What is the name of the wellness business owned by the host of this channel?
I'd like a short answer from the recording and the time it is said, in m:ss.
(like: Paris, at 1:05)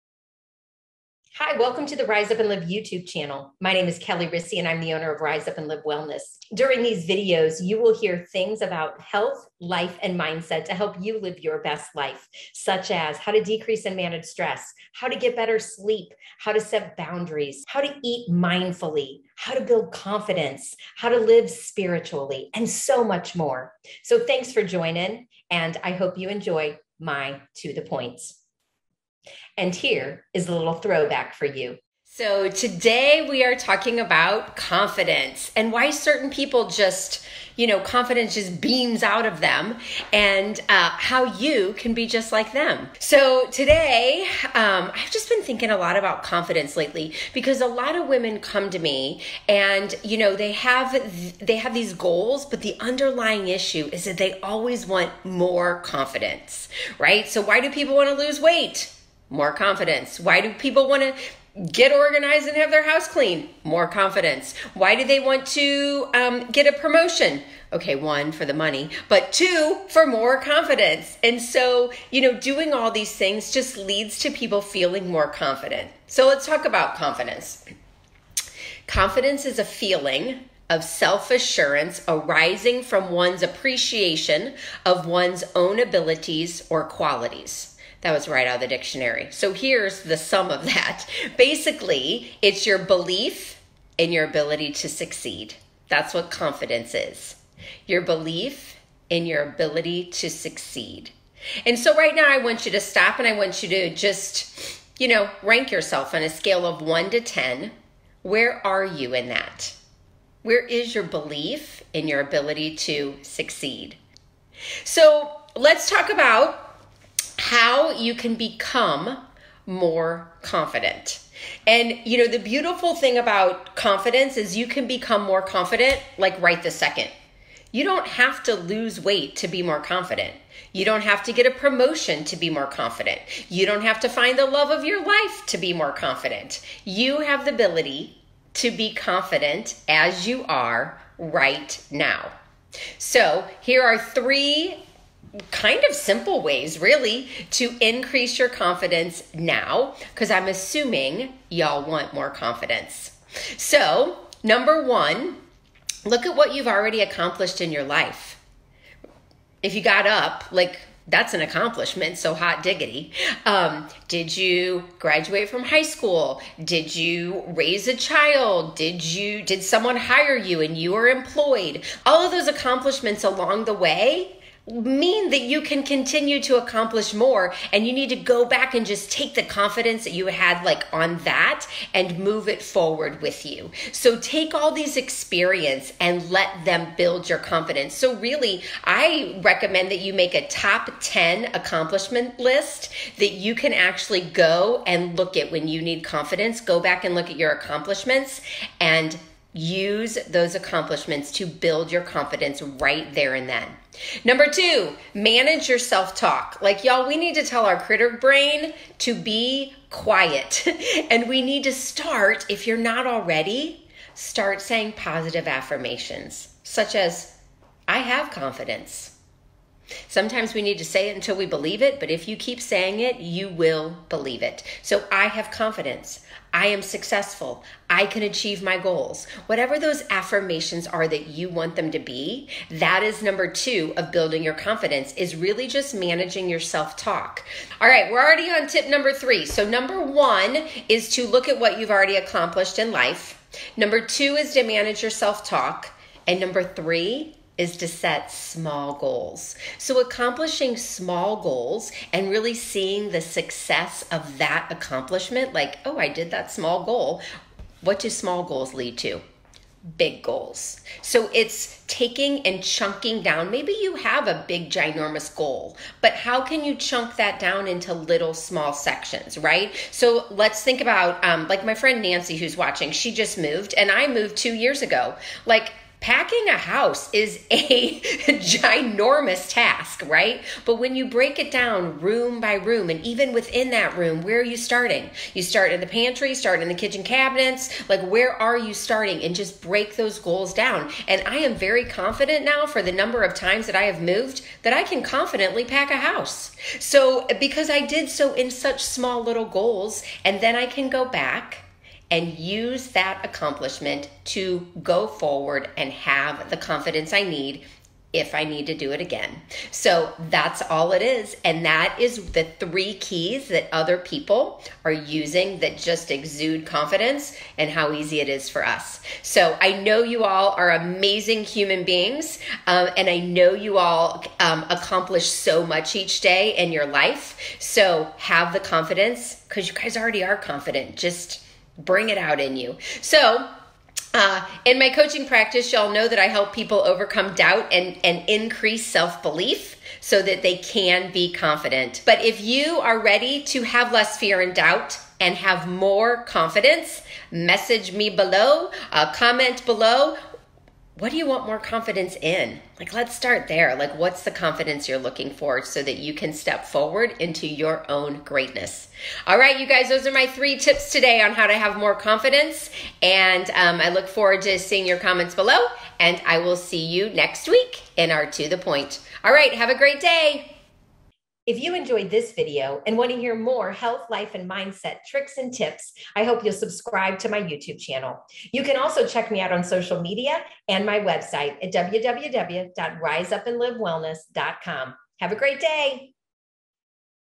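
Rise Up and Live Wellness, at 0:05.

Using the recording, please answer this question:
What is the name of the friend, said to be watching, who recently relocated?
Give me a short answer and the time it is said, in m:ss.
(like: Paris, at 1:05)
Nancy, at 4:32.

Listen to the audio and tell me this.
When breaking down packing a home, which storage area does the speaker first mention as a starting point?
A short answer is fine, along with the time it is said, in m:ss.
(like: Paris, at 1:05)
The pantry, at 4:45.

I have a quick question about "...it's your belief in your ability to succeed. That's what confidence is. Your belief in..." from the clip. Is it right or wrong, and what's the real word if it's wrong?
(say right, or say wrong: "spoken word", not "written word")
right.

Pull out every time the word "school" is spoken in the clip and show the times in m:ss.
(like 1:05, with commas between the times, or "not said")
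2:45.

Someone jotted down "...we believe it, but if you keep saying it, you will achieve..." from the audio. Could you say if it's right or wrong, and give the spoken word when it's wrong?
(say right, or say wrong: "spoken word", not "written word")
wrong: "believe", not "achieve".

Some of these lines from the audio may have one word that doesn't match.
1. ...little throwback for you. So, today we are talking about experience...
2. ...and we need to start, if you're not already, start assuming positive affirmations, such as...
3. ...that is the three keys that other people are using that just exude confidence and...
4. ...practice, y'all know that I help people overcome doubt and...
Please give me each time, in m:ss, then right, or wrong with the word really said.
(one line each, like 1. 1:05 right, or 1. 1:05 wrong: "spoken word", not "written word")
1. 0:30 wrong: "confidence", not "experience"
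2. 3:31 wrong: "saying", not "assuming"
3. 5:11 right
4. 5:35 right.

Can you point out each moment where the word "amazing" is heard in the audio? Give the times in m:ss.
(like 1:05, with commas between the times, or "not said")
5:20.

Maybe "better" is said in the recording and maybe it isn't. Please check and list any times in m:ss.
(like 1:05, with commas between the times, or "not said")
0:15.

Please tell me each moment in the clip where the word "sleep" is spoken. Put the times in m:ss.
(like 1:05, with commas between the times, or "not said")
0:15.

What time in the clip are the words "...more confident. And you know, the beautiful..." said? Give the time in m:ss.
1:59.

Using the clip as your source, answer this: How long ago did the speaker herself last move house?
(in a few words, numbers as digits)
2 years ago.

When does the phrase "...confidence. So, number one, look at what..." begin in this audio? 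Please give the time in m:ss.
2:32.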